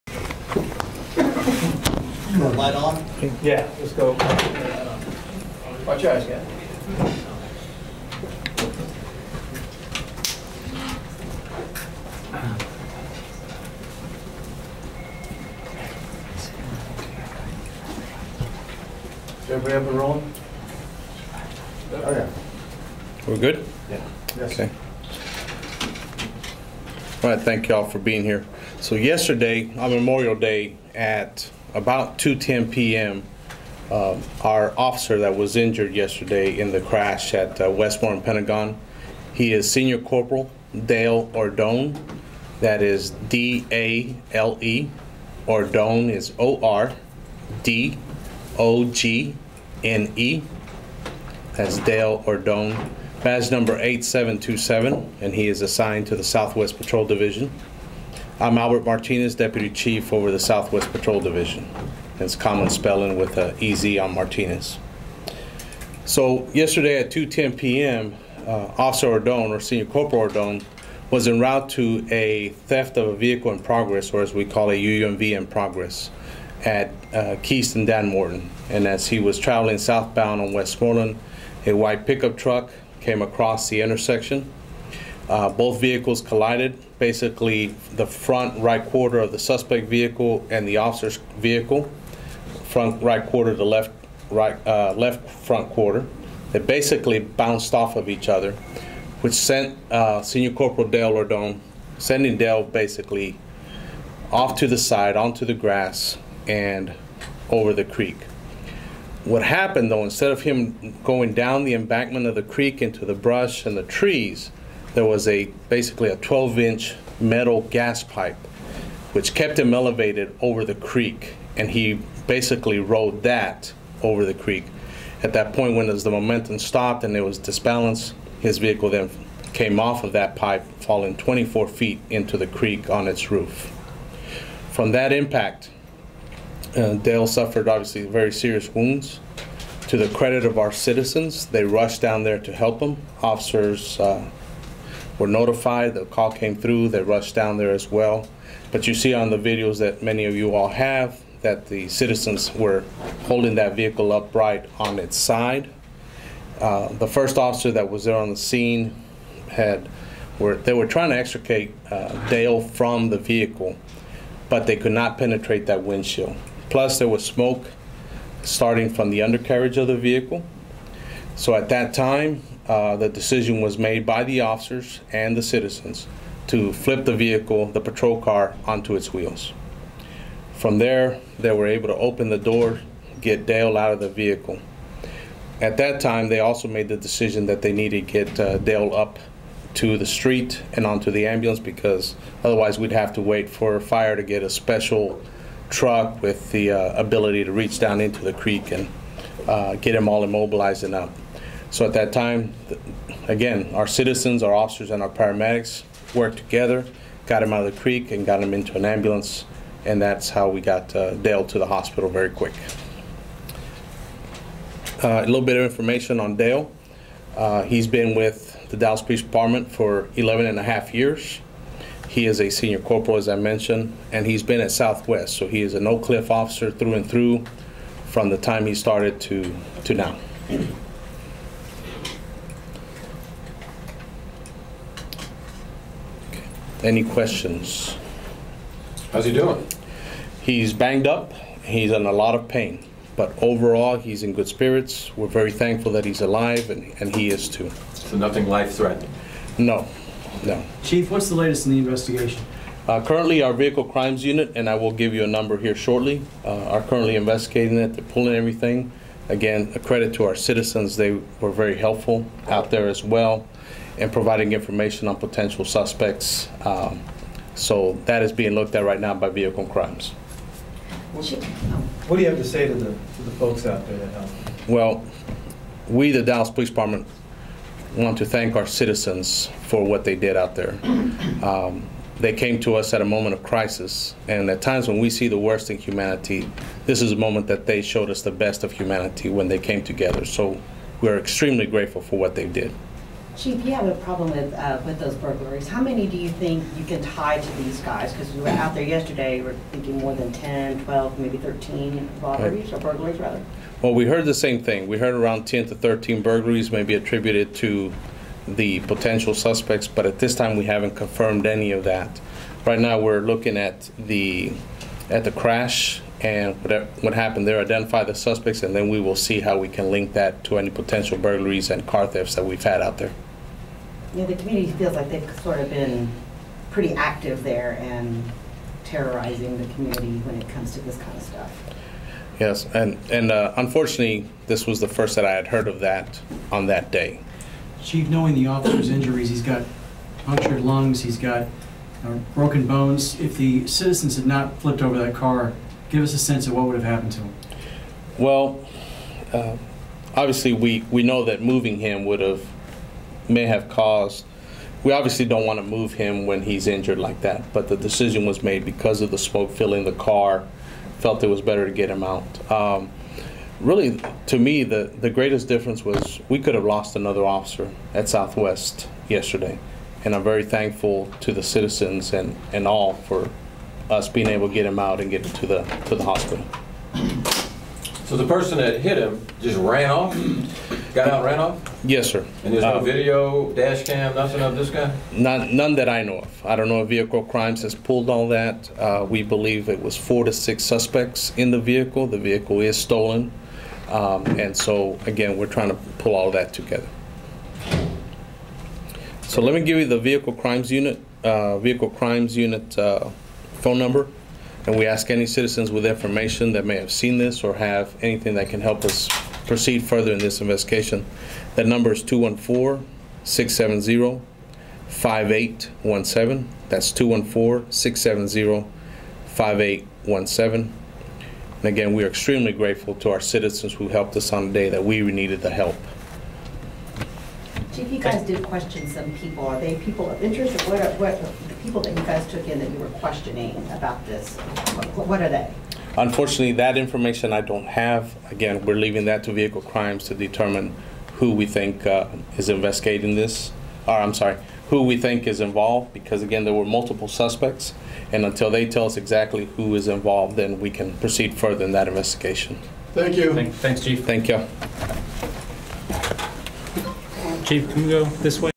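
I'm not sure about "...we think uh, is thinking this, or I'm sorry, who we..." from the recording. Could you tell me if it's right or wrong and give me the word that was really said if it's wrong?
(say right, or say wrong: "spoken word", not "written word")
wrong: "investigating", not "thinking".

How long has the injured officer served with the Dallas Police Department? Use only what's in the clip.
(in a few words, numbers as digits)
11 and a half years.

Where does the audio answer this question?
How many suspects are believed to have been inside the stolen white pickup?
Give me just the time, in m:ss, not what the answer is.
6:29.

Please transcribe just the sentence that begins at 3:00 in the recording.
From there, they were able to open the door, get Dale out of the vehicle.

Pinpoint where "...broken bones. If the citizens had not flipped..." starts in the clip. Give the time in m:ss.
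5:42.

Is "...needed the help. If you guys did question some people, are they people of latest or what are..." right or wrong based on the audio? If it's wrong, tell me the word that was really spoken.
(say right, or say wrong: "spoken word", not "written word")
wrong: "interest", not "latest".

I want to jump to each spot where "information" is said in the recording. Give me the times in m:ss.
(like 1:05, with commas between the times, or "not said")
3:35, 4:24, 6:45, 7:16.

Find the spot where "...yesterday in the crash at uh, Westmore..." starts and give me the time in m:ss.
0:35.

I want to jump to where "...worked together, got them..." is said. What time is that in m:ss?
3:26.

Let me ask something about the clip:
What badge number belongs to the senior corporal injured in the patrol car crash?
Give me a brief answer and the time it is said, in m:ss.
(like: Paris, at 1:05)
8727, at 0:53.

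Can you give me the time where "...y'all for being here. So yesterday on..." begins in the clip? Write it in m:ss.
0:27.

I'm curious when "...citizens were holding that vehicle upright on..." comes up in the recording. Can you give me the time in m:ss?
2:31.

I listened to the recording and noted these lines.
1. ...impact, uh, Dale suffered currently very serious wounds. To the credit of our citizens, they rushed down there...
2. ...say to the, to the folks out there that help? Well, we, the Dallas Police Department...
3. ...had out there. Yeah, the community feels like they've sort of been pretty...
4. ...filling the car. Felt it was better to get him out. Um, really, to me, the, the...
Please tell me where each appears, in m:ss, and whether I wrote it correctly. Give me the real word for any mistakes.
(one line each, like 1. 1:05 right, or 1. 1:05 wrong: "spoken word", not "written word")
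1. 2:15 wrong: "obviously", not "currently"
2. 4:32 right
3. 5:22 right
4. 5:59 right.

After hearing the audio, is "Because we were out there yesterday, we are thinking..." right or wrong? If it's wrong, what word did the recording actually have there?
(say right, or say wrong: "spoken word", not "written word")
right.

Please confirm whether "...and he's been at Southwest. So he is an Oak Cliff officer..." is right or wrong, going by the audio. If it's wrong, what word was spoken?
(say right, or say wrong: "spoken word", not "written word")
right.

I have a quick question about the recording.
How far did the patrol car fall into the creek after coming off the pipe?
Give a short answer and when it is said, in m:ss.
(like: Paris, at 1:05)
24 feet, at 2:11.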